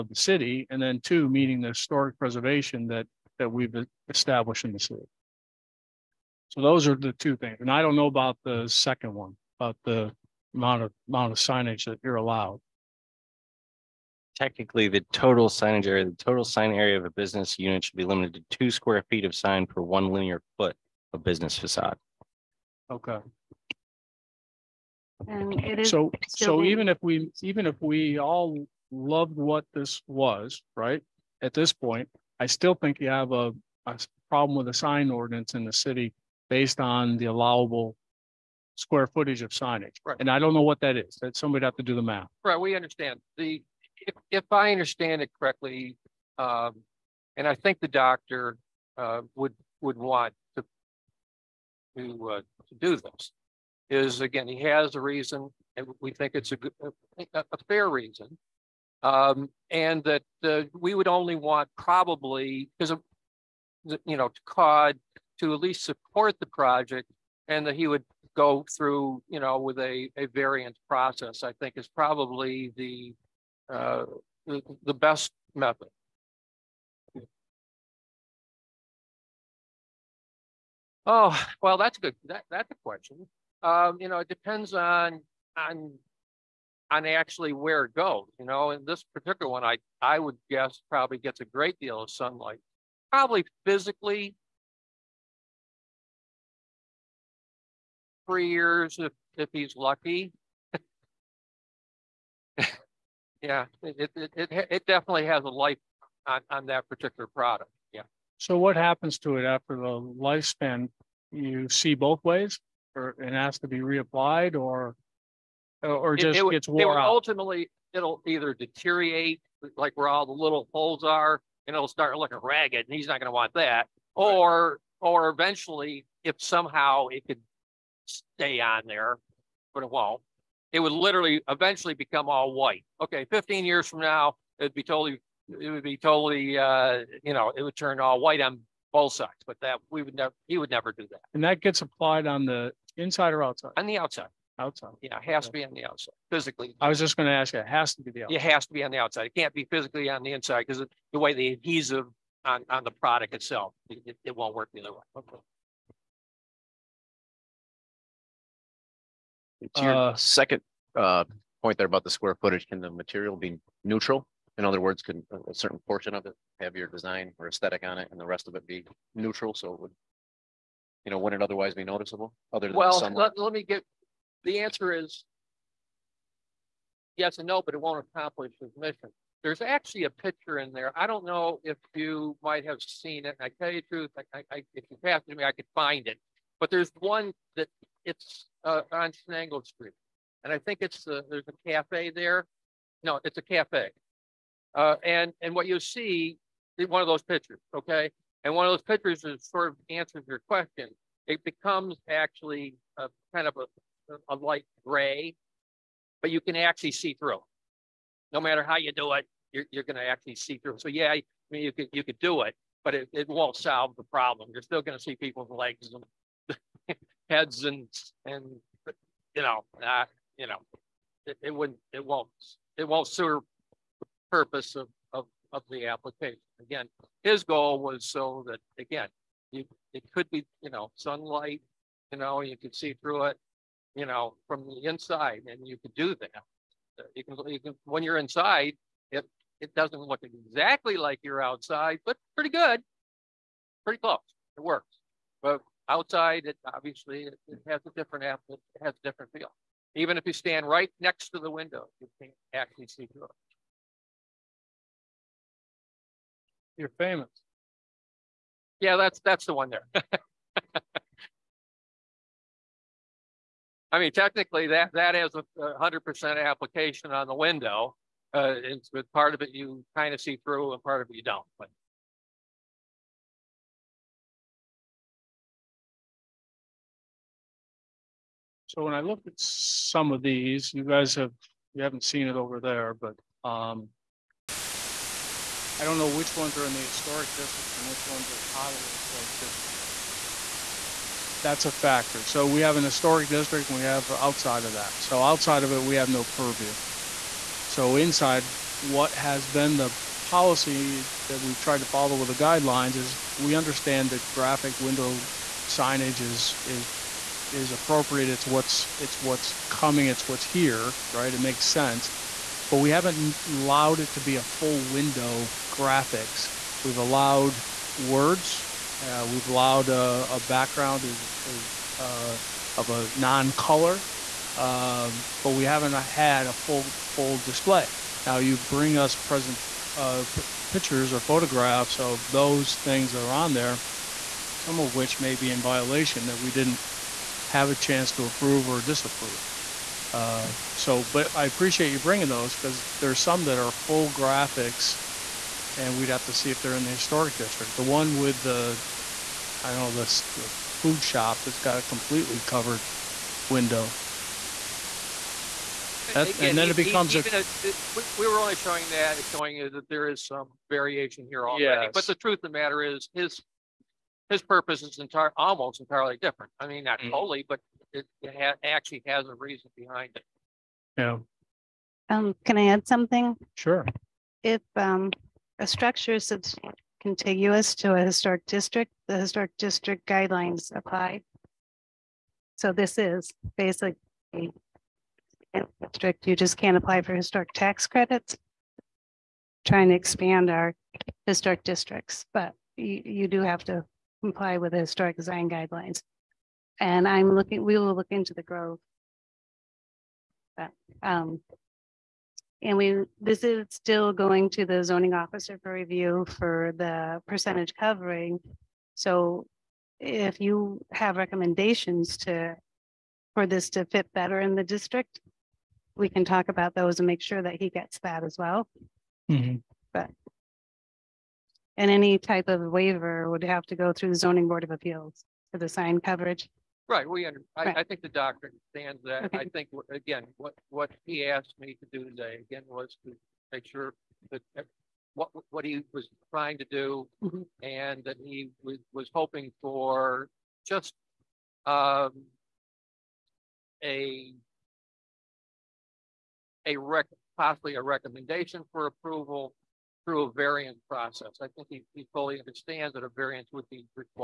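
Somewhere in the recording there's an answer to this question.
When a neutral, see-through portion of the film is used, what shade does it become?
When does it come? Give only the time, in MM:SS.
03:24.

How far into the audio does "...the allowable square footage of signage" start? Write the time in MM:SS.
00:37.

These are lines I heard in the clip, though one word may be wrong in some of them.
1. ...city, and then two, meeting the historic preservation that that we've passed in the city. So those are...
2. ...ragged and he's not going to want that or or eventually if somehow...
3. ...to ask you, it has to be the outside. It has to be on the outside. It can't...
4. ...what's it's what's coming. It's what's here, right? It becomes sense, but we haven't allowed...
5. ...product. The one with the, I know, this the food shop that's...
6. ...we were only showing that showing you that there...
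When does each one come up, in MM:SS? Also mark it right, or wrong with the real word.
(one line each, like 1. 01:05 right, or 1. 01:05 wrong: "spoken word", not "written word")
1. 00:00 wrong: "established", not "passed"
2. 02:02 right
3. 02:27 right
4. 05:08 wrong: "makes", not "becomes"
5. 05:47 wrong: "district", not "product"
6. 05:58 right.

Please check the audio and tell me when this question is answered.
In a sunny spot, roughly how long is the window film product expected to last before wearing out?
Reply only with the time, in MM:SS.
01:38.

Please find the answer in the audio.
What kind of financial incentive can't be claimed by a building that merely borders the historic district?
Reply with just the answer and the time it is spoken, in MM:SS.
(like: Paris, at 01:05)
Historic tax credits, at 06:27.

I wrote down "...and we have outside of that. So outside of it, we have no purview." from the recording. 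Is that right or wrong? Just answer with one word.
right.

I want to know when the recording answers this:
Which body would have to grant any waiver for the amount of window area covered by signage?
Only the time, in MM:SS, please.
07:04.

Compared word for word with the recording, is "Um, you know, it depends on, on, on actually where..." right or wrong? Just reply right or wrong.
right.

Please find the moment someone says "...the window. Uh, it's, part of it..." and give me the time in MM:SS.
04:27.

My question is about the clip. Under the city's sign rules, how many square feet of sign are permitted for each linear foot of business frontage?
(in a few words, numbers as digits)
2 square feet.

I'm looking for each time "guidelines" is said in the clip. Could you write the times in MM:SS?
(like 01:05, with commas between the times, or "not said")
05:02, 06:20, 06:35.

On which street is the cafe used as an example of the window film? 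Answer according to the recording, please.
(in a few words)
Chenango Street.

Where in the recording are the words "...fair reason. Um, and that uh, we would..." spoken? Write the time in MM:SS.
00:57.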